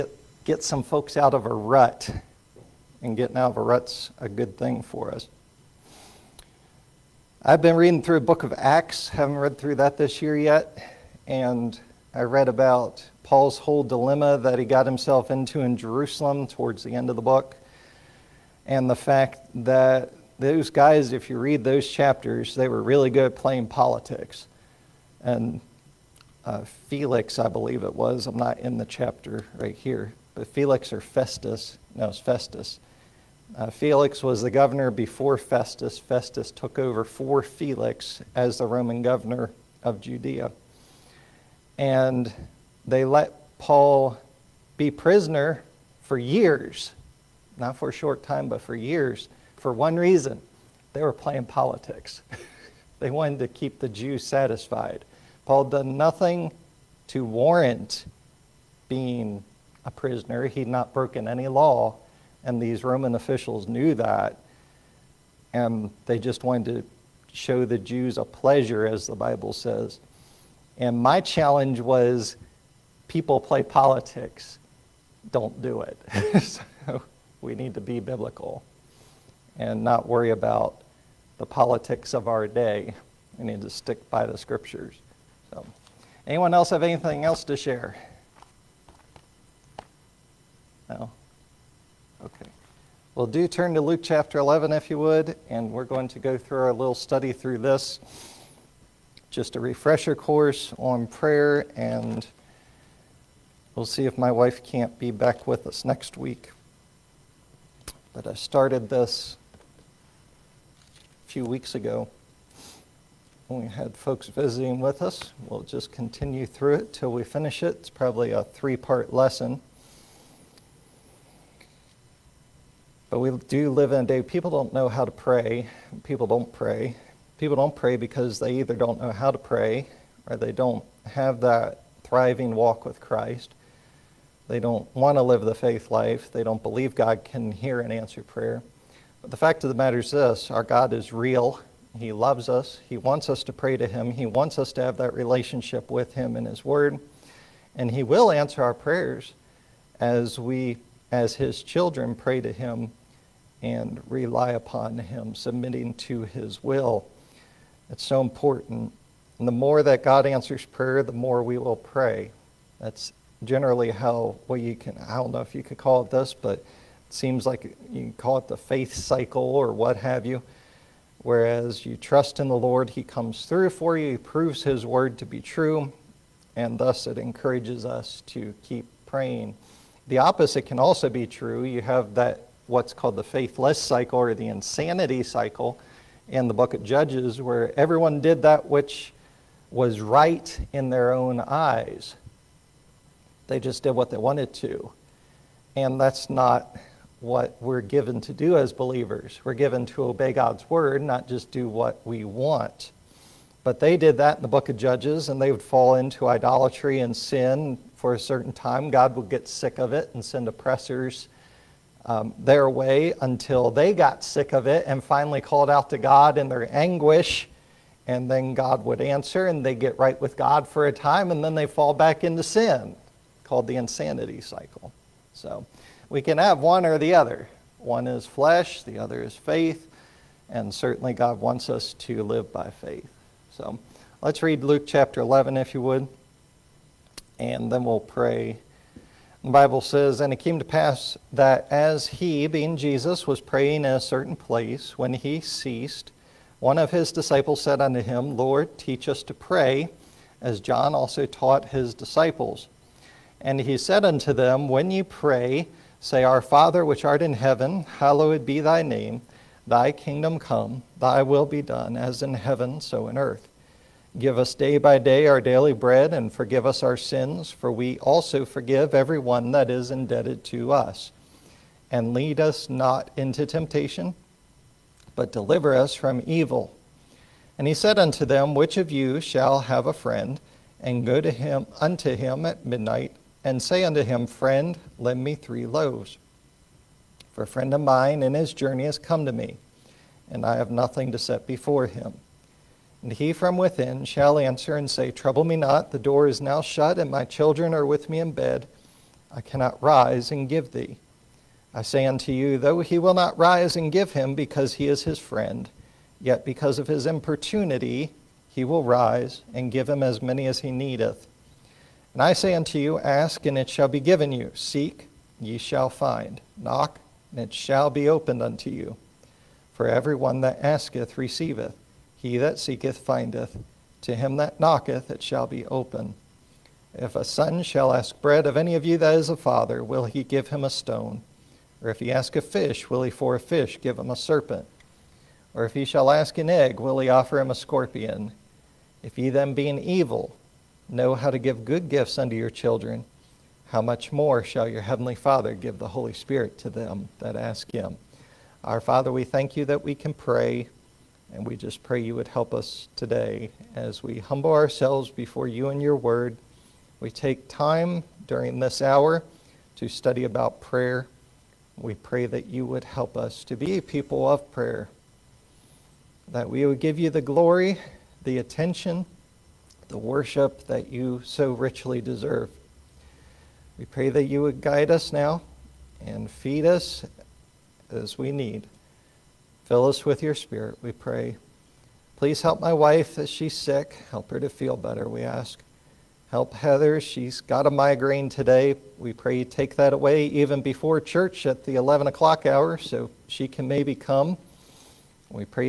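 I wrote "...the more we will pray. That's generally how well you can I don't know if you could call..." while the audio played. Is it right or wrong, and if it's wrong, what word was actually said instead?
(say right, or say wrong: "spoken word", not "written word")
right.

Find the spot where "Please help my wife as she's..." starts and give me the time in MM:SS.
06:22.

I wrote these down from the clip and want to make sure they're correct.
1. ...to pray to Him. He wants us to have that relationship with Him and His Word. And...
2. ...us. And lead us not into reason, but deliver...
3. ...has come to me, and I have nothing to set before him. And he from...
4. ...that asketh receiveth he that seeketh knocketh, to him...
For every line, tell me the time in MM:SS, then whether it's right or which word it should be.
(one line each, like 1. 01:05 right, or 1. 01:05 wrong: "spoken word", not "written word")
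1. 02:23 right
2. 04:30 wrong: "temptation", not "reason"
3. 04:48 right
4. 05:20 wrong: "findeth", not "knocketh".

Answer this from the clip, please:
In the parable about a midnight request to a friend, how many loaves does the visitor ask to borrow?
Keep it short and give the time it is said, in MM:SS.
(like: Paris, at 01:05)
3, at 04:45.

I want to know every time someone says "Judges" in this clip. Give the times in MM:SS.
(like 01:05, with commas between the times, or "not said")
03:06, 03:24.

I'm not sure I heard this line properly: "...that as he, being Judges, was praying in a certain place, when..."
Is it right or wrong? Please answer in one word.
wrong.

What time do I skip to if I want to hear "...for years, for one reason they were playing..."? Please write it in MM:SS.
00:48.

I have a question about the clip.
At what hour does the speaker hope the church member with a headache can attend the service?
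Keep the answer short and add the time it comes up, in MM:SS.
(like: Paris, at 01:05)
11 o'clock, at 06:31.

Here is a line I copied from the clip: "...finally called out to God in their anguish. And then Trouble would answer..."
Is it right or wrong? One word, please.
wrong.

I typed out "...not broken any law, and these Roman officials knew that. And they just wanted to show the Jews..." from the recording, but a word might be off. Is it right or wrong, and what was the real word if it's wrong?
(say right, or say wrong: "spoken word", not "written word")
right.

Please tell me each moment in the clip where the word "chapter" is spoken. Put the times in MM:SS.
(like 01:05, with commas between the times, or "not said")
00:21, 00:28, 01:34, 03:54.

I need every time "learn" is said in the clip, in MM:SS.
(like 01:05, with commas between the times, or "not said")
not said.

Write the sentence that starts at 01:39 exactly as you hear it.
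Just a refresher course on prayer, and we'll see if my wife can't be back with us next week.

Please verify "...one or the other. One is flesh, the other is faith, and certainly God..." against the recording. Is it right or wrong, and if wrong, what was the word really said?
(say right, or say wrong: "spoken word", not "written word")
right.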